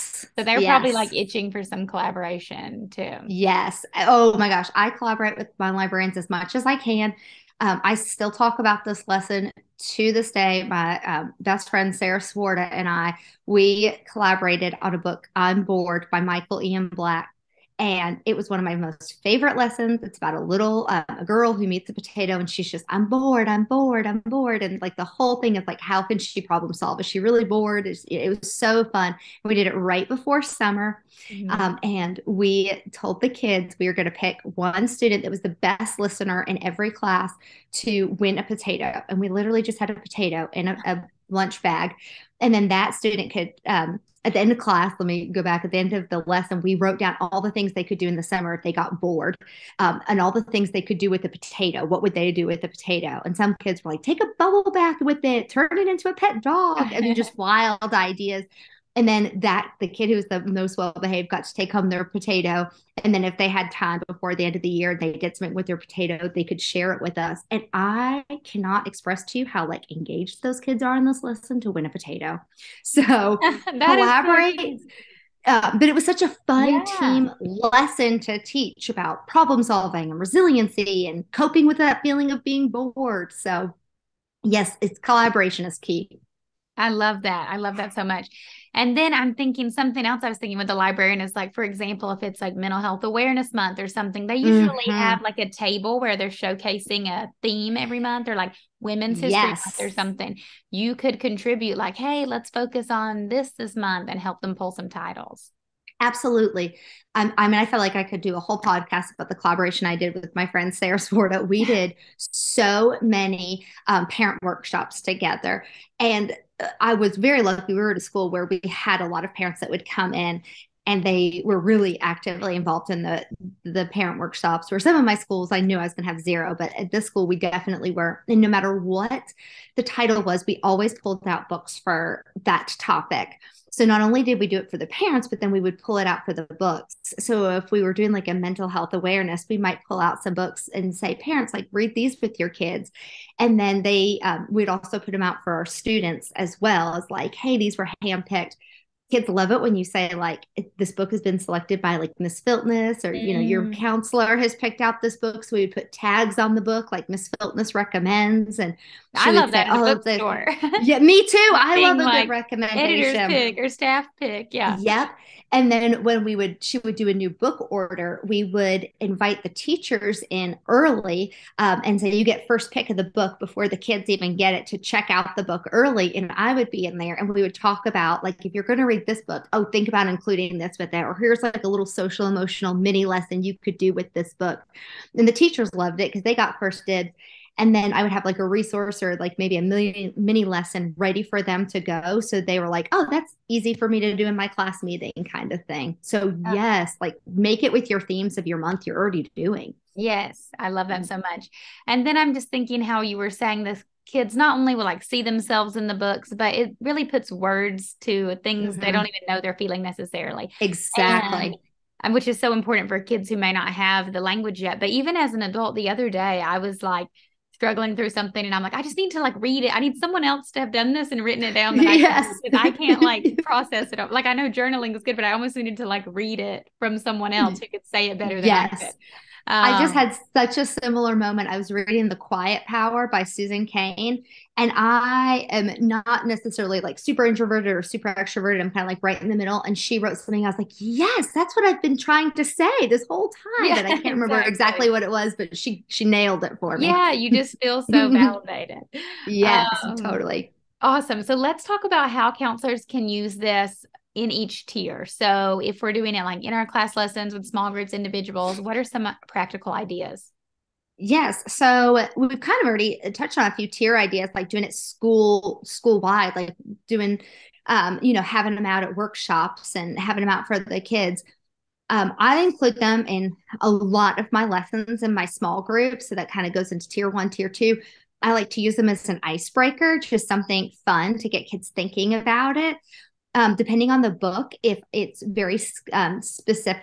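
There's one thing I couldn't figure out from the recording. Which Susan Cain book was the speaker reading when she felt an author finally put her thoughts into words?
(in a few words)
The Quiet Power.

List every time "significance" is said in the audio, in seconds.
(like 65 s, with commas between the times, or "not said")
not said.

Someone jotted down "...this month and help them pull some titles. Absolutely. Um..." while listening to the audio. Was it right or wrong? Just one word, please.
right.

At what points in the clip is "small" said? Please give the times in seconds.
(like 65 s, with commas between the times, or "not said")
257 s, 275 s.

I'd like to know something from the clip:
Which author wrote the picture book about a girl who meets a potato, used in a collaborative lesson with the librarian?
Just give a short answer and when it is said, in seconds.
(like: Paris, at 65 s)
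Michael Ian Black, at 16 s.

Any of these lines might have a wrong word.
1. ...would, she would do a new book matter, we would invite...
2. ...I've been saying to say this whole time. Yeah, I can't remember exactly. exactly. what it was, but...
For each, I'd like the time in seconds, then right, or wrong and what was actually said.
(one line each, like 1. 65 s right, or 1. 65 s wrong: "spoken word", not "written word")
1. 166 s wrong: "order", not "matter"
2. 241 s wrong: "trying", not "saying".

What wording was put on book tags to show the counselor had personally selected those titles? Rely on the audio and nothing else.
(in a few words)
Miss Filtness recommends.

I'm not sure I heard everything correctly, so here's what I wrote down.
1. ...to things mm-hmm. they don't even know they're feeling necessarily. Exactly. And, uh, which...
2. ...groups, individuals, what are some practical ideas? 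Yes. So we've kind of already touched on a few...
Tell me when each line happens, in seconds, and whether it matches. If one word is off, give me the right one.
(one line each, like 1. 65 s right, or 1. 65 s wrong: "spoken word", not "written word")
1. 208 s right
2. 257 s right.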